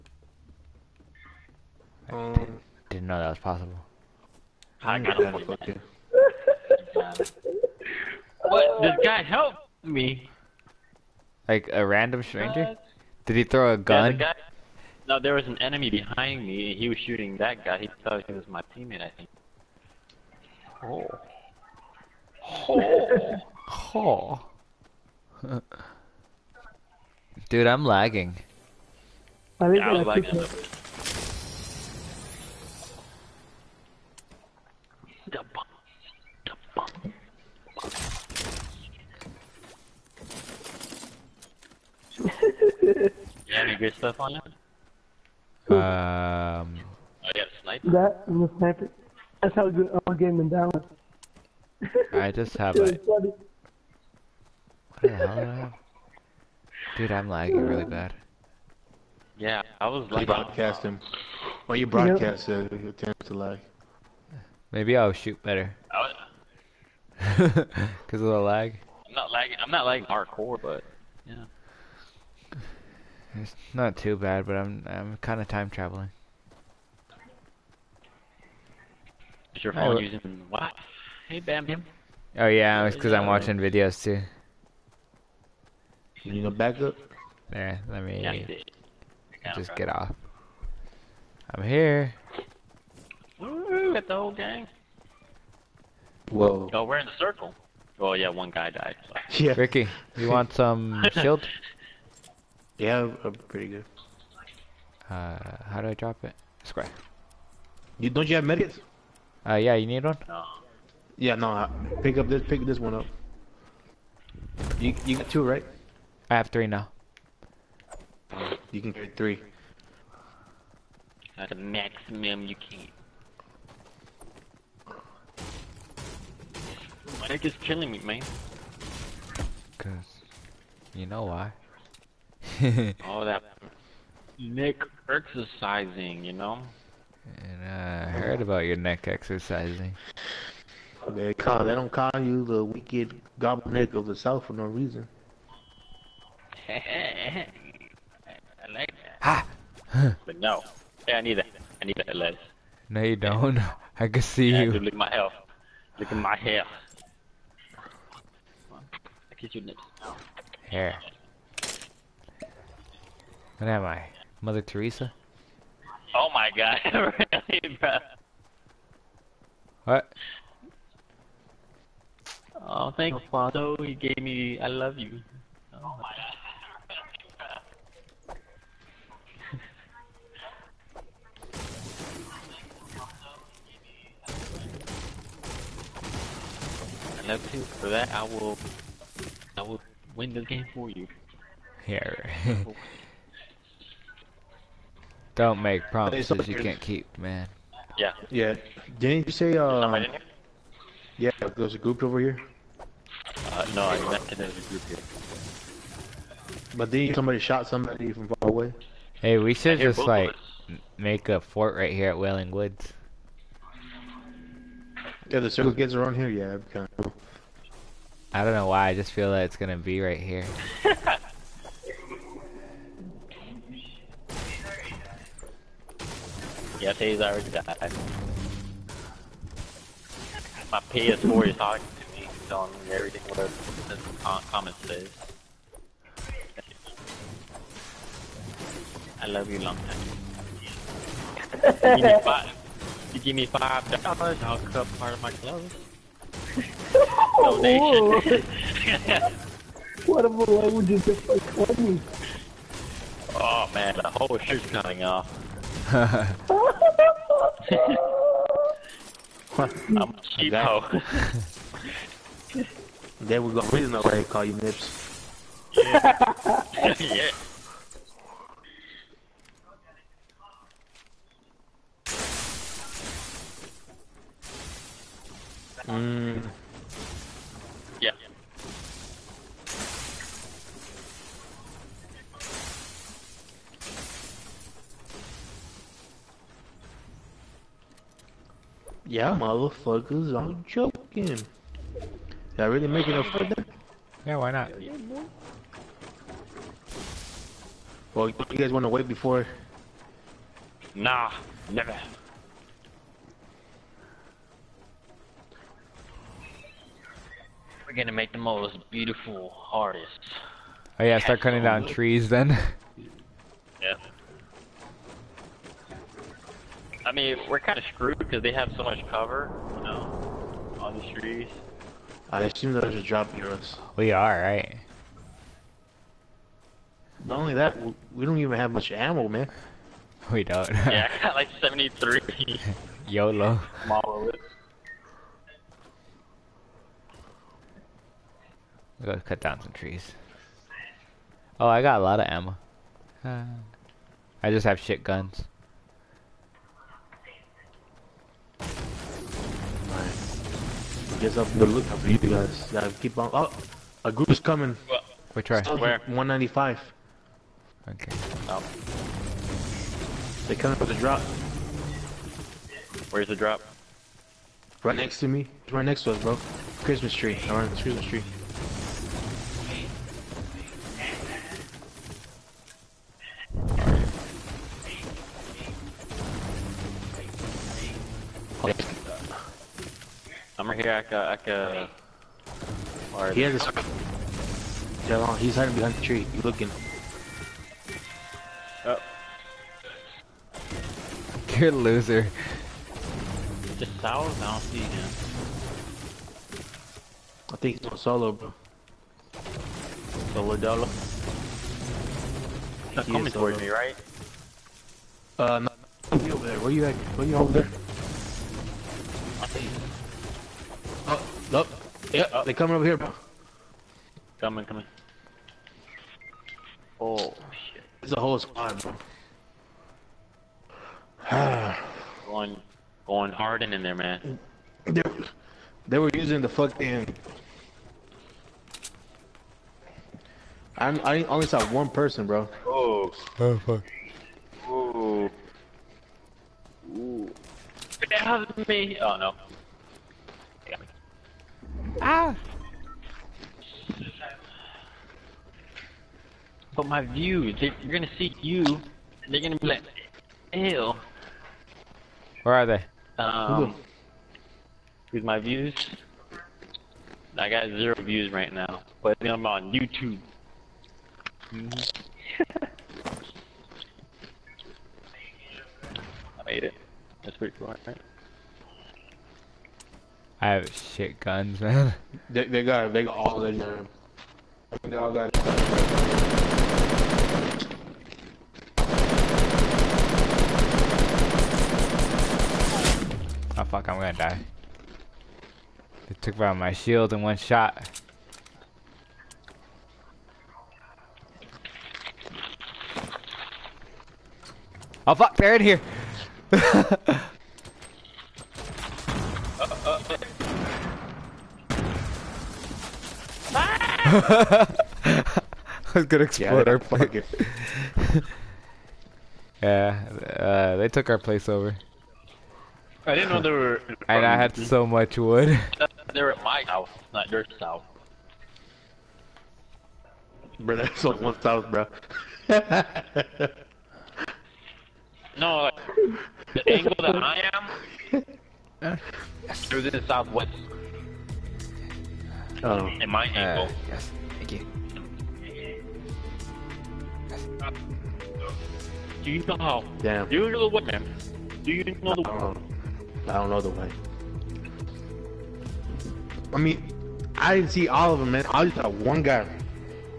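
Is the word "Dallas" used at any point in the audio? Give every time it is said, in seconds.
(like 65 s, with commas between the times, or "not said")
50 s.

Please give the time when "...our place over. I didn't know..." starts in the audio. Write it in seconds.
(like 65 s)
511 s.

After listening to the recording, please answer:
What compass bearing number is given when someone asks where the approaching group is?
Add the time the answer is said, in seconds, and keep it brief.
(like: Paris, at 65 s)
195, at 356 s.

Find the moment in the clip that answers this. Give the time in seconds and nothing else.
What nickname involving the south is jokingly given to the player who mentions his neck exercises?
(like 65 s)
142 s.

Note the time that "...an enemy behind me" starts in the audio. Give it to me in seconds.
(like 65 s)
15 s.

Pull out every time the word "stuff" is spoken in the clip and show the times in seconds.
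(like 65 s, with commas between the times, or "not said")
43 s.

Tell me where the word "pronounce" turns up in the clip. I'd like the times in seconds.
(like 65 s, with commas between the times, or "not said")
not said.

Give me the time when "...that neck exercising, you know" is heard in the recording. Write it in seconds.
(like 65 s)
133 s.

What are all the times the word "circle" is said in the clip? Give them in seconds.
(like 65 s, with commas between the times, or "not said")
97 s, 215 s.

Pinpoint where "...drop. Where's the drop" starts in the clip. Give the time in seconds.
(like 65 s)
360 s.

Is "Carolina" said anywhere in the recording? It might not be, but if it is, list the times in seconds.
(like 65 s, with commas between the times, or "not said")
not said.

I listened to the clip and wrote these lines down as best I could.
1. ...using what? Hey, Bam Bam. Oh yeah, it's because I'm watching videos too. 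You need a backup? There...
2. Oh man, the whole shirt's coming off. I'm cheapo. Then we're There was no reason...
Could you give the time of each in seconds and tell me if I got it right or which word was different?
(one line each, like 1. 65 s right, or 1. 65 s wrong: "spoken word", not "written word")
1. 80 s right
2. 253 s right.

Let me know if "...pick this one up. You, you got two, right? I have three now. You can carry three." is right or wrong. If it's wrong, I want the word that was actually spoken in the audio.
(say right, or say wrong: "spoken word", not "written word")
right.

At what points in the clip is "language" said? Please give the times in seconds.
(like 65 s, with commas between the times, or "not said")
250 s.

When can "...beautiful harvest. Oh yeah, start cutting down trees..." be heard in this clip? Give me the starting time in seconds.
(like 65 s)
308 s.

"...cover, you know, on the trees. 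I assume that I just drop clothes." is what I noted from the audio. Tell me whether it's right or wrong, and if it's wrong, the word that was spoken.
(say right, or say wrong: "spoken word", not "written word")
wrong: "heroes", not "clothes".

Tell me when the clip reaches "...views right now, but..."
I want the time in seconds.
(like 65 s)
458 s.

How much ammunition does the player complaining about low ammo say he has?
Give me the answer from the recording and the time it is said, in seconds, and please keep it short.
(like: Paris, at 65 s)
73, at 331 s.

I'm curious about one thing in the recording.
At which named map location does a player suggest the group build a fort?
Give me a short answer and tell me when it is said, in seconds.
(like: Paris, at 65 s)
Wailing Woods, at 212 s.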